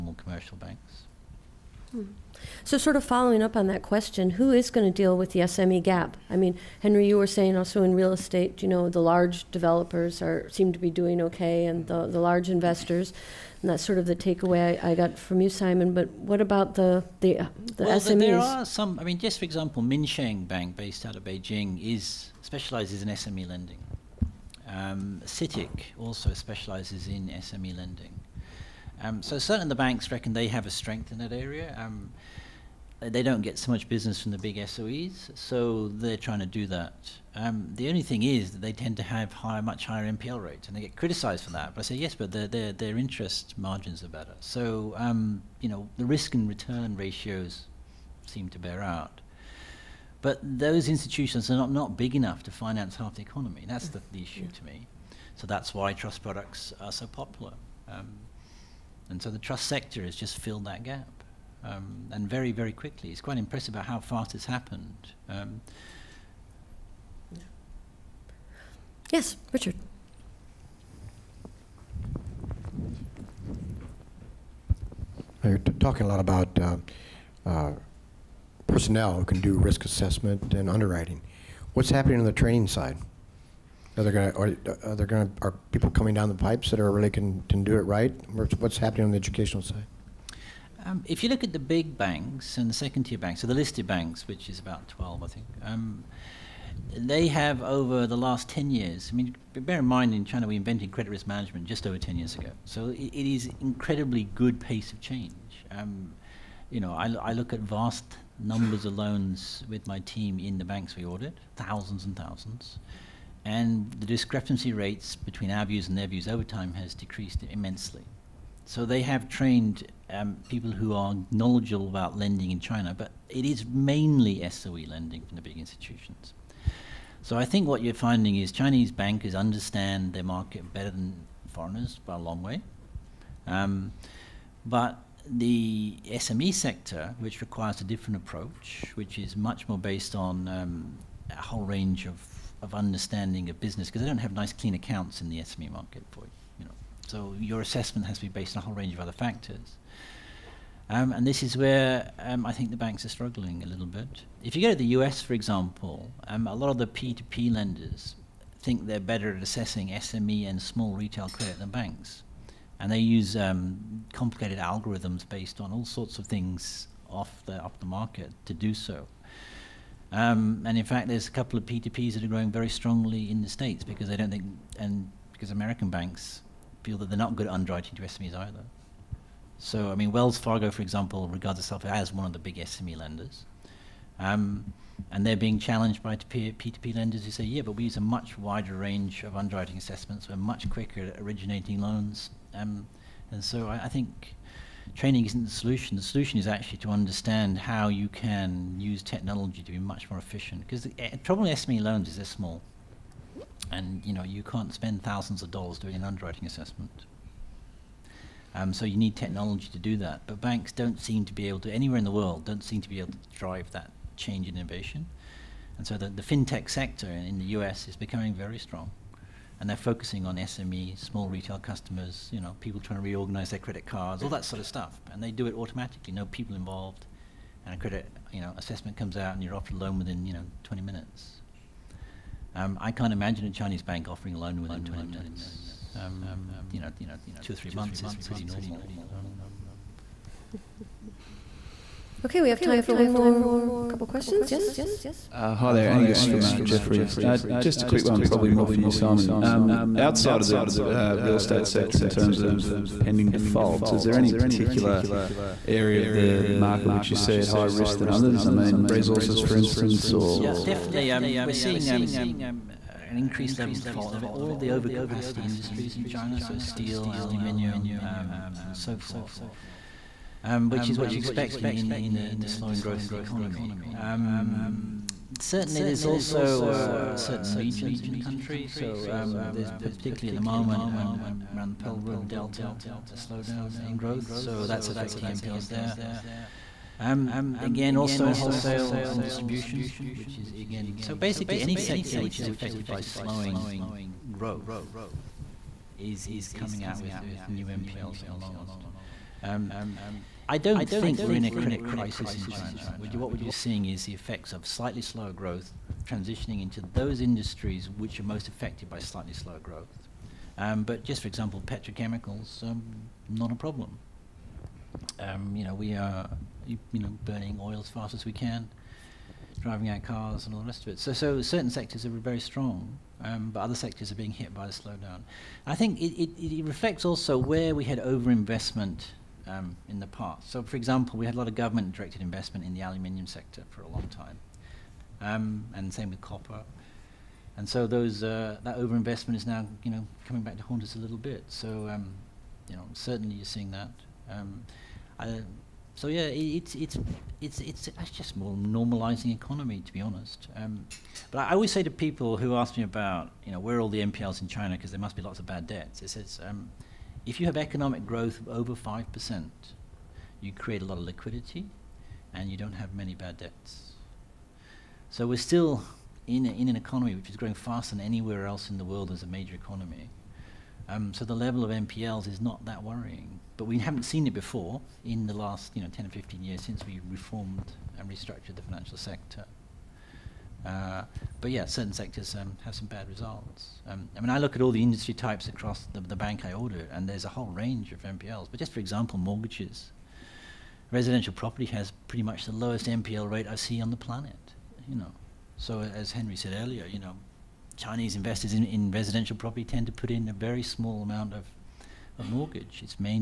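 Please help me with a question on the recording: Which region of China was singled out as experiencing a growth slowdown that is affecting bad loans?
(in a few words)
Pearl River Delta.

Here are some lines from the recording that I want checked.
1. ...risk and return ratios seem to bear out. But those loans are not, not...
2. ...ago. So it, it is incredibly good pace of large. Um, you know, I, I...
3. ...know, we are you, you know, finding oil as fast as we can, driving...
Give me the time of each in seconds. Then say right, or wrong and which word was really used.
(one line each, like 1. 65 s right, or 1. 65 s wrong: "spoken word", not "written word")
1. 46 s wrong: "institutions", not "loans"
2. 102 s wrong: "change", not "large"
3. 315 s wrong: "burning", not "finding".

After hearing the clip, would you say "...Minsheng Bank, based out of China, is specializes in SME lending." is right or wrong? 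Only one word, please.
wrong.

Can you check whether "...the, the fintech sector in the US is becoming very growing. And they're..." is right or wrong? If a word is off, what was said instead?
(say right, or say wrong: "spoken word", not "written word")
wrong: "strong", not "growing".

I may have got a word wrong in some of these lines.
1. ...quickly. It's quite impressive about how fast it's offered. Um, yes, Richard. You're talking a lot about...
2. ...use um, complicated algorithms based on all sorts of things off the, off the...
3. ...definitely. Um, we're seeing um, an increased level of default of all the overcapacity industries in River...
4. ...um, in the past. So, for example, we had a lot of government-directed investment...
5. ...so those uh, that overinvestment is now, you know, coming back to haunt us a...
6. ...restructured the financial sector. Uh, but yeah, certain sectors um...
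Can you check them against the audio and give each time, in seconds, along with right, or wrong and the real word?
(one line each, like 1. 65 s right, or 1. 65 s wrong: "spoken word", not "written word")
1. 62 s wrong: "happened", not "offered"
2. 162 s right
3. 260 s wrong: "China", not "River"
4. 329 s right
5. 337 s right
6. 378 s right.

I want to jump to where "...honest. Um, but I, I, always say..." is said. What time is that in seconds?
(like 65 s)
350 s.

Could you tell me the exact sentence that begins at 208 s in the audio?
Um, so you need technology to do that.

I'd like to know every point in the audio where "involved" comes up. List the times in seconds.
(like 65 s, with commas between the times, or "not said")
226 s.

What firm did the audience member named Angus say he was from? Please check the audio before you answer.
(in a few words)
Jefferies.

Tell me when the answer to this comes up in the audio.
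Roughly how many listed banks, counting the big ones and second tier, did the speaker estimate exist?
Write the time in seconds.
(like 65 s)
94 s.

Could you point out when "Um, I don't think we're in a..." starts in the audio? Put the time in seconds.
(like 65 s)
299 s.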